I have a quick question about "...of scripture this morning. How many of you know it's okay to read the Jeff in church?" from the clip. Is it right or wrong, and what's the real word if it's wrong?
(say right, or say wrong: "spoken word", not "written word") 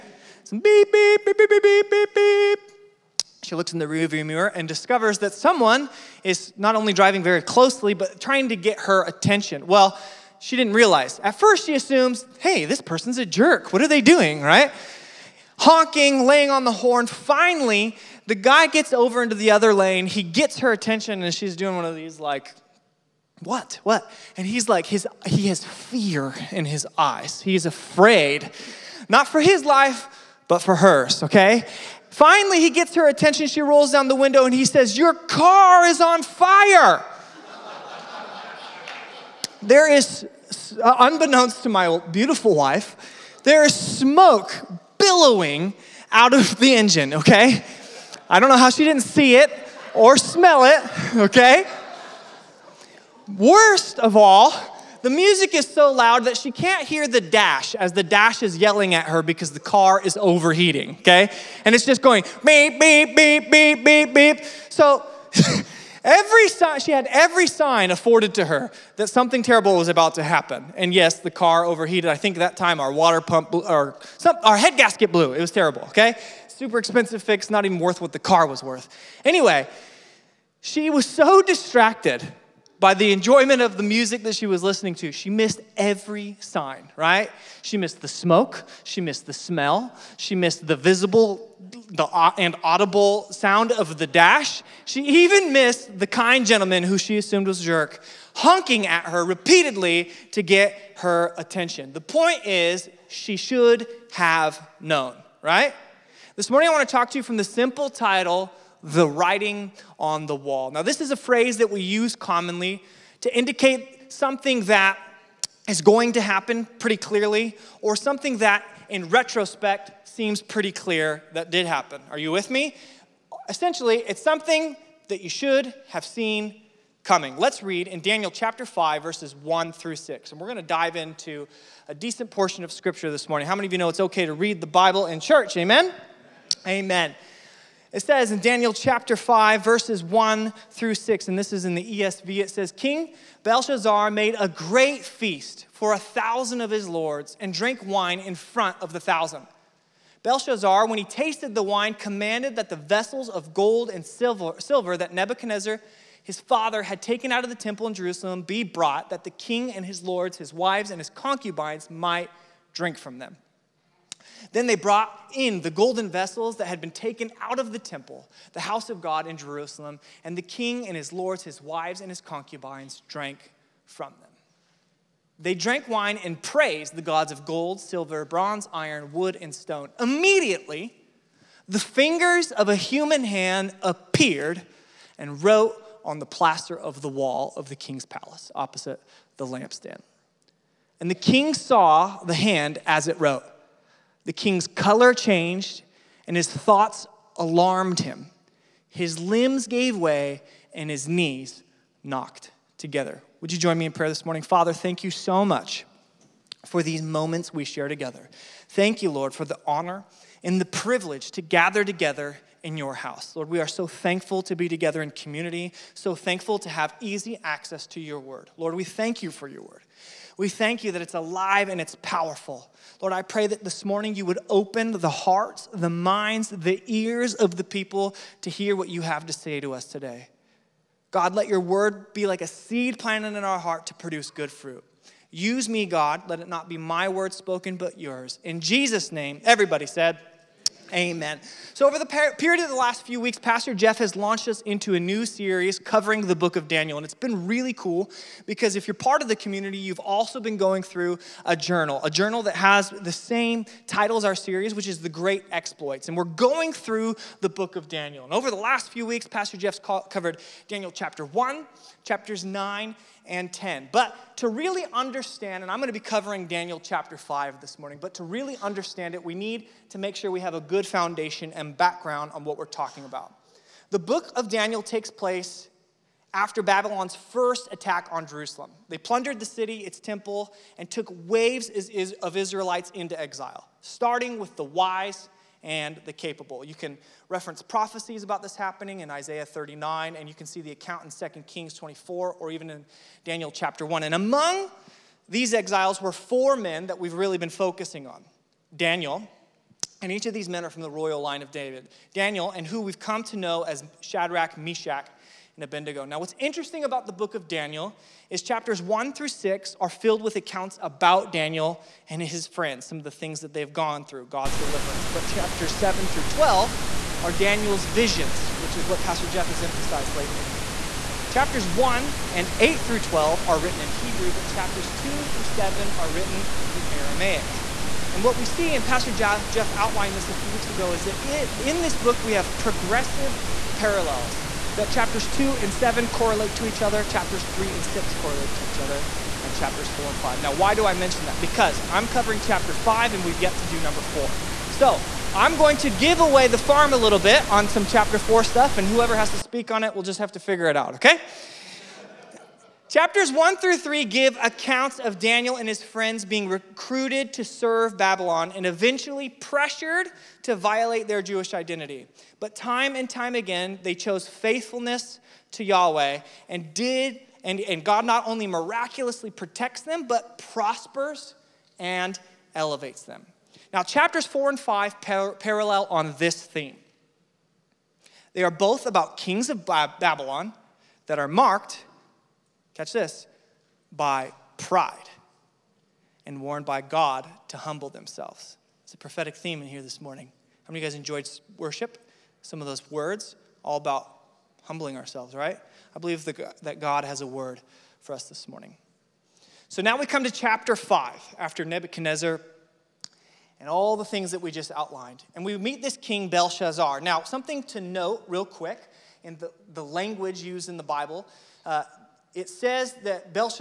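wrong: "Bible", not "Jeff".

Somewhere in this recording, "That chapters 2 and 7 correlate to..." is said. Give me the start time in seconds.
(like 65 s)
334 s.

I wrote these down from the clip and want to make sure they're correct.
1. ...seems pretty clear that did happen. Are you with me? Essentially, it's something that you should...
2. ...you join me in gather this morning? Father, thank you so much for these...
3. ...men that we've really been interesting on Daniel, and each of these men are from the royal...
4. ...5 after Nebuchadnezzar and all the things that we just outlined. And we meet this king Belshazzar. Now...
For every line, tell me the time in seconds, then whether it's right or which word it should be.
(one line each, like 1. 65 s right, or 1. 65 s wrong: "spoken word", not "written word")
1. 120 s right
2. 203 s wrong: "prayer", not "gather"
3. 296 s wrong: "focusing", not "interesting"
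4. 400 s right.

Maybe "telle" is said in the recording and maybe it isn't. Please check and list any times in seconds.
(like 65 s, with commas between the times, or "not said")
not said.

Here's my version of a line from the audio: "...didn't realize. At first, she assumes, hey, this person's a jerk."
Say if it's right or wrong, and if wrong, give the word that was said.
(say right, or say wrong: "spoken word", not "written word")
right.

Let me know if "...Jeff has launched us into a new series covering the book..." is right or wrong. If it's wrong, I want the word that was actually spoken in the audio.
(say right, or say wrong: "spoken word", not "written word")
right.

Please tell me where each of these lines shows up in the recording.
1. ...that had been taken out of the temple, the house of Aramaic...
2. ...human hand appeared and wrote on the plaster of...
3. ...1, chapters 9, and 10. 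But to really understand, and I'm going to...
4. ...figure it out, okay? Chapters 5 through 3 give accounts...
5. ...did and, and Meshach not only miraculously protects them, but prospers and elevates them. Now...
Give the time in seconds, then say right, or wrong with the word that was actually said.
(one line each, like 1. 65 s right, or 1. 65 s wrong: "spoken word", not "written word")
1. 166 s wrong: "God", not "Aramaic"
2. 182 s right
3. 261 s right
4. 350 s wrong: "1", not "5"
5. 366 s wrong: "God", not "Meshach".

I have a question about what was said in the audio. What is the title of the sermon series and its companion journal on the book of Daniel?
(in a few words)
The Great Exploits.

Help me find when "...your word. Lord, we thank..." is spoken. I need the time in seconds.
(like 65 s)
218 s.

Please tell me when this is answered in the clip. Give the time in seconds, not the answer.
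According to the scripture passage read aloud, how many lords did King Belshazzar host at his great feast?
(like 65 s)
145 s.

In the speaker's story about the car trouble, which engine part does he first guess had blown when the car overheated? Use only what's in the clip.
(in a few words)
water pump.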